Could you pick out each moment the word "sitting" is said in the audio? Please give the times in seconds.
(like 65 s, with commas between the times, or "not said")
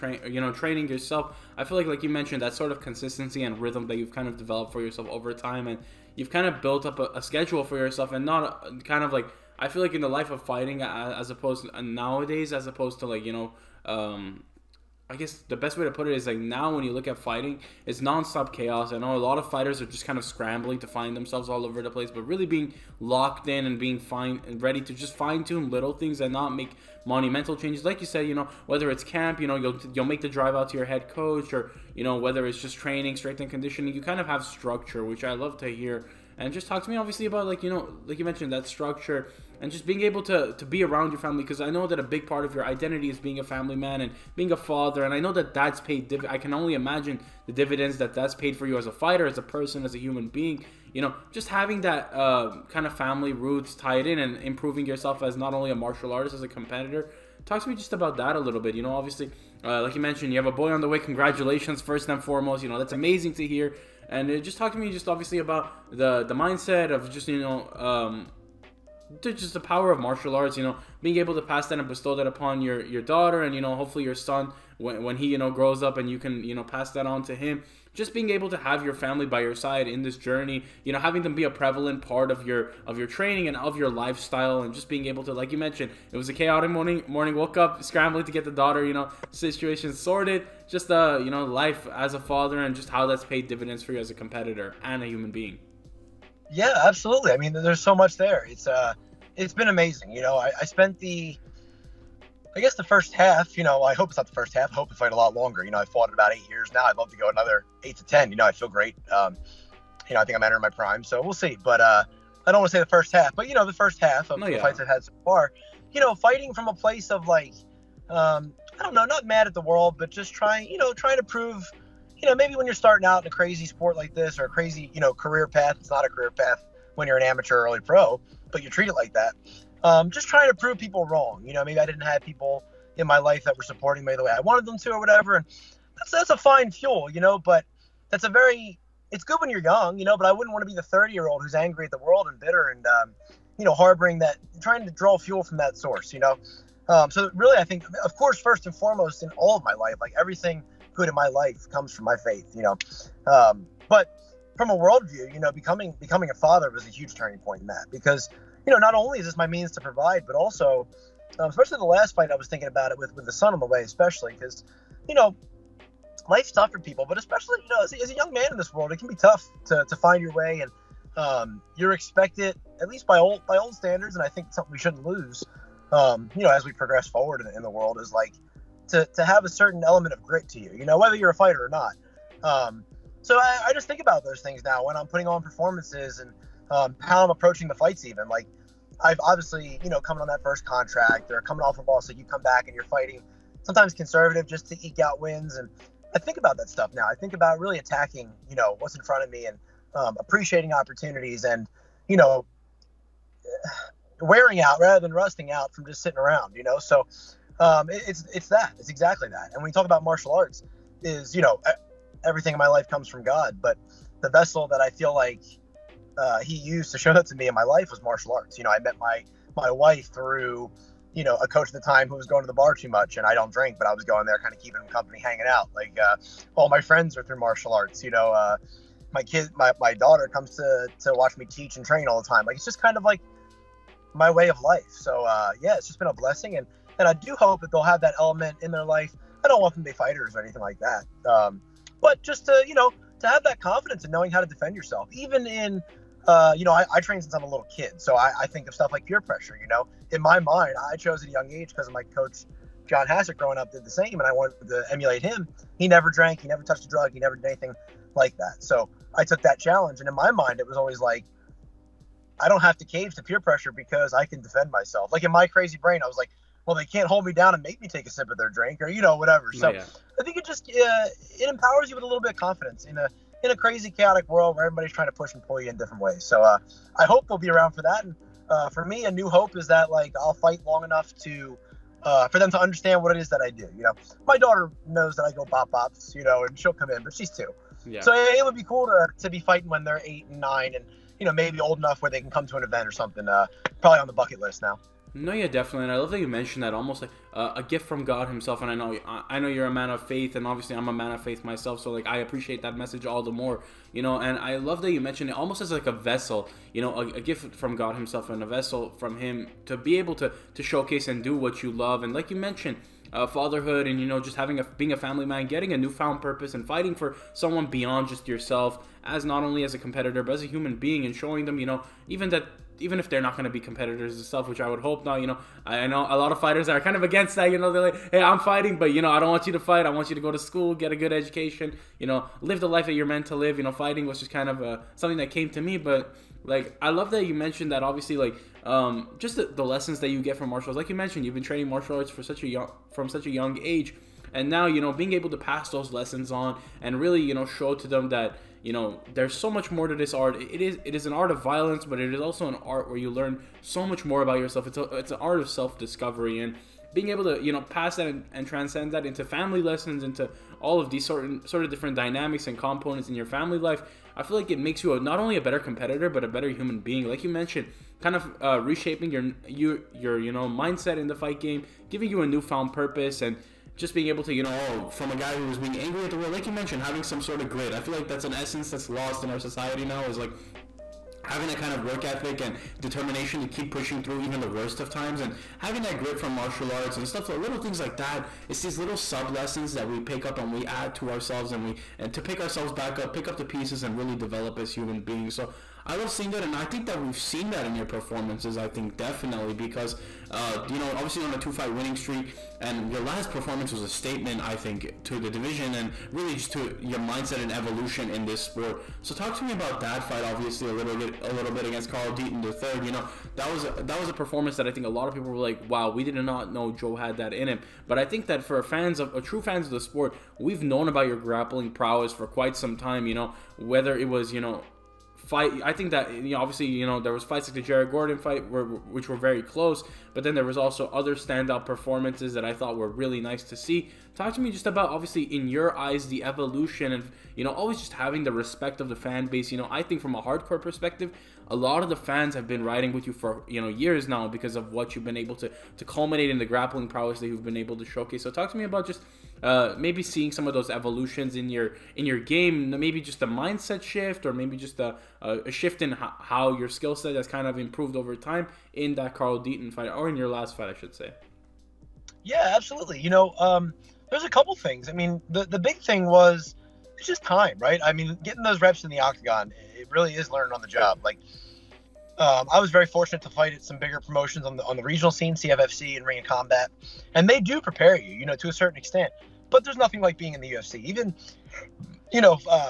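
206 s.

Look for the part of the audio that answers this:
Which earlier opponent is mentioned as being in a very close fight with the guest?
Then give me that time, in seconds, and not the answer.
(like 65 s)
427 s.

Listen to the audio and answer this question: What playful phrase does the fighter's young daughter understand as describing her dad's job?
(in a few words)
bop bops.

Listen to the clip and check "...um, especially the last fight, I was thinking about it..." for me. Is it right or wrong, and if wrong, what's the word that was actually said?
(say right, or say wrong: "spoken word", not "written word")
right.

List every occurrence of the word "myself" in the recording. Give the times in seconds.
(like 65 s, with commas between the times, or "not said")
264 s, 301 s.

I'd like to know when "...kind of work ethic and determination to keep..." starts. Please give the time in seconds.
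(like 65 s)
381 s.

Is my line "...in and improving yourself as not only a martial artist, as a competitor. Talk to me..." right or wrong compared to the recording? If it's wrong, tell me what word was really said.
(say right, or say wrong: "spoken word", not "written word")
right.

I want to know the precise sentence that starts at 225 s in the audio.
Like uh, all my friends are through martial arts.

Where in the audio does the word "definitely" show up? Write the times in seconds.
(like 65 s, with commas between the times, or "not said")
295 s, 398 s.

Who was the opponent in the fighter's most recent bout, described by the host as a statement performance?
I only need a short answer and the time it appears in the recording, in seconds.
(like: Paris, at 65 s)
Carl Deaton the third, at 411 s.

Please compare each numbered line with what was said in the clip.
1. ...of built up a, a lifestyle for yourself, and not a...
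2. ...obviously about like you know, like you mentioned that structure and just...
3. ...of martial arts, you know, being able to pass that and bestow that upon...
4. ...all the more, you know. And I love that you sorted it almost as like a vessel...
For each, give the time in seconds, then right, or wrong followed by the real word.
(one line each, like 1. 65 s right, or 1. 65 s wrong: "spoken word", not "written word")
1. 6 s wrong: "schedule", not "lifestyle"
2. 36 s right
3. 69 s right
4. 303 s wrong: "mentioned", not "sorted".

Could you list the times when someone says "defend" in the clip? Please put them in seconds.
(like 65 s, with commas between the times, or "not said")
244 s, 264 s.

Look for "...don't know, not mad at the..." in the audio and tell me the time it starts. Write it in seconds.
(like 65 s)
118 s.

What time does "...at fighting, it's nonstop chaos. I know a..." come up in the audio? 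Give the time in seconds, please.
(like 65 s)
17 s.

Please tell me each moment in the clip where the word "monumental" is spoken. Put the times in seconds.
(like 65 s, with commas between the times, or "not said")
27 s.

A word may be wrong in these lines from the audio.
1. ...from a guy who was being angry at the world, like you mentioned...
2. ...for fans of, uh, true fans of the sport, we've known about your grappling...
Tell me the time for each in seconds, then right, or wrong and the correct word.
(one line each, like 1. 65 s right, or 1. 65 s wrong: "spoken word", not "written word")
1. 374 s right
2. 418 s right.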